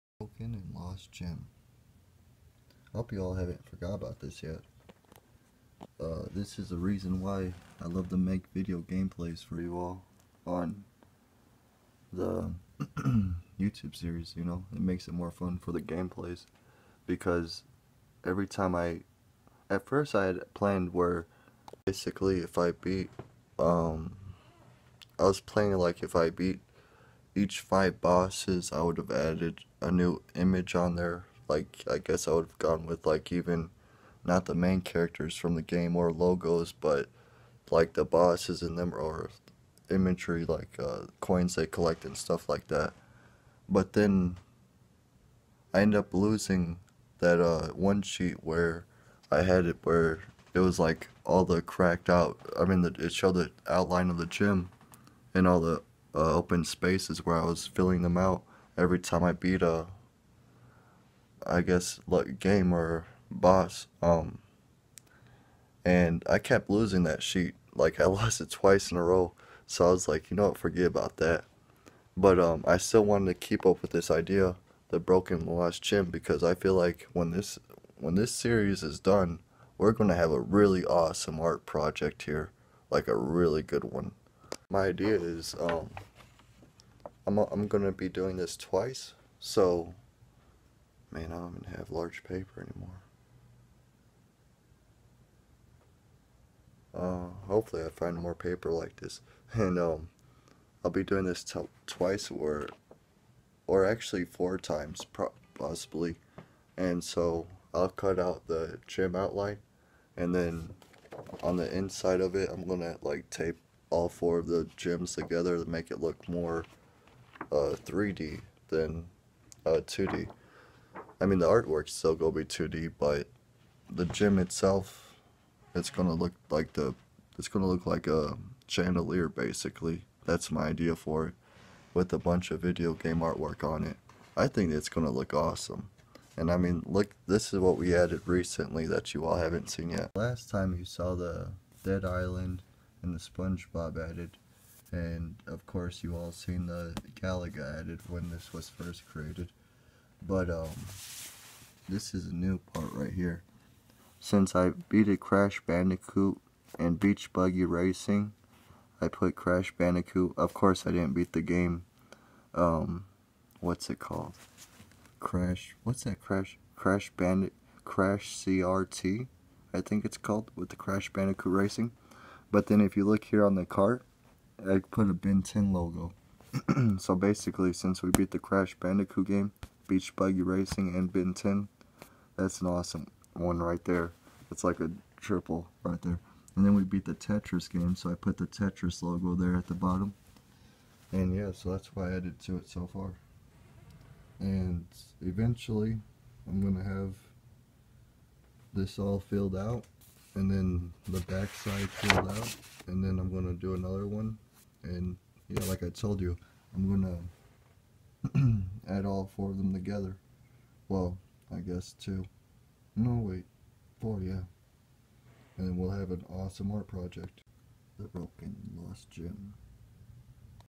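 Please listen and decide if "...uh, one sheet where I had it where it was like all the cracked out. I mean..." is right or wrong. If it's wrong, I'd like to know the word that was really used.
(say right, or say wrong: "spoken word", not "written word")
right.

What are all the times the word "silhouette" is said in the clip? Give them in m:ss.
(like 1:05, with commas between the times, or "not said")
not said.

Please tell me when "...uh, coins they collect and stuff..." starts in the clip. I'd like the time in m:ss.
0:40.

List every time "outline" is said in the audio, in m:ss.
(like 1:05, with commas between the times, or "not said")
0:53, 1:49.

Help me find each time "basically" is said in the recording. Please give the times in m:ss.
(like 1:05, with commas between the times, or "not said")
0:21, 2:09, 2:57.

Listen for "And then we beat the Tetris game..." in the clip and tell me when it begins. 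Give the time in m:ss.
3:06.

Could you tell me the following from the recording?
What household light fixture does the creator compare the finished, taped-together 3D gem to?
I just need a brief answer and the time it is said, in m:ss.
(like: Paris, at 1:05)
a chandelier, at 2:08.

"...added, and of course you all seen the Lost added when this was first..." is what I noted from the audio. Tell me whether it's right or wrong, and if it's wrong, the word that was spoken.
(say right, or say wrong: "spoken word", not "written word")
wrong: "Galaga", not "Lost".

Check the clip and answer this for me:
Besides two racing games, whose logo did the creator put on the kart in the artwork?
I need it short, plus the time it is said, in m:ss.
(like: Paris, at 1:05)
Ben 10, at 2:55.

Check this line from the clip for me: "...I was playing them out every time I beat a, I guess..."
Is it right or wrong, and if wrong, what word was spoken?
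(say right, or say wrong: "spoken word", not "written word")
wrong: "filling", not "playing".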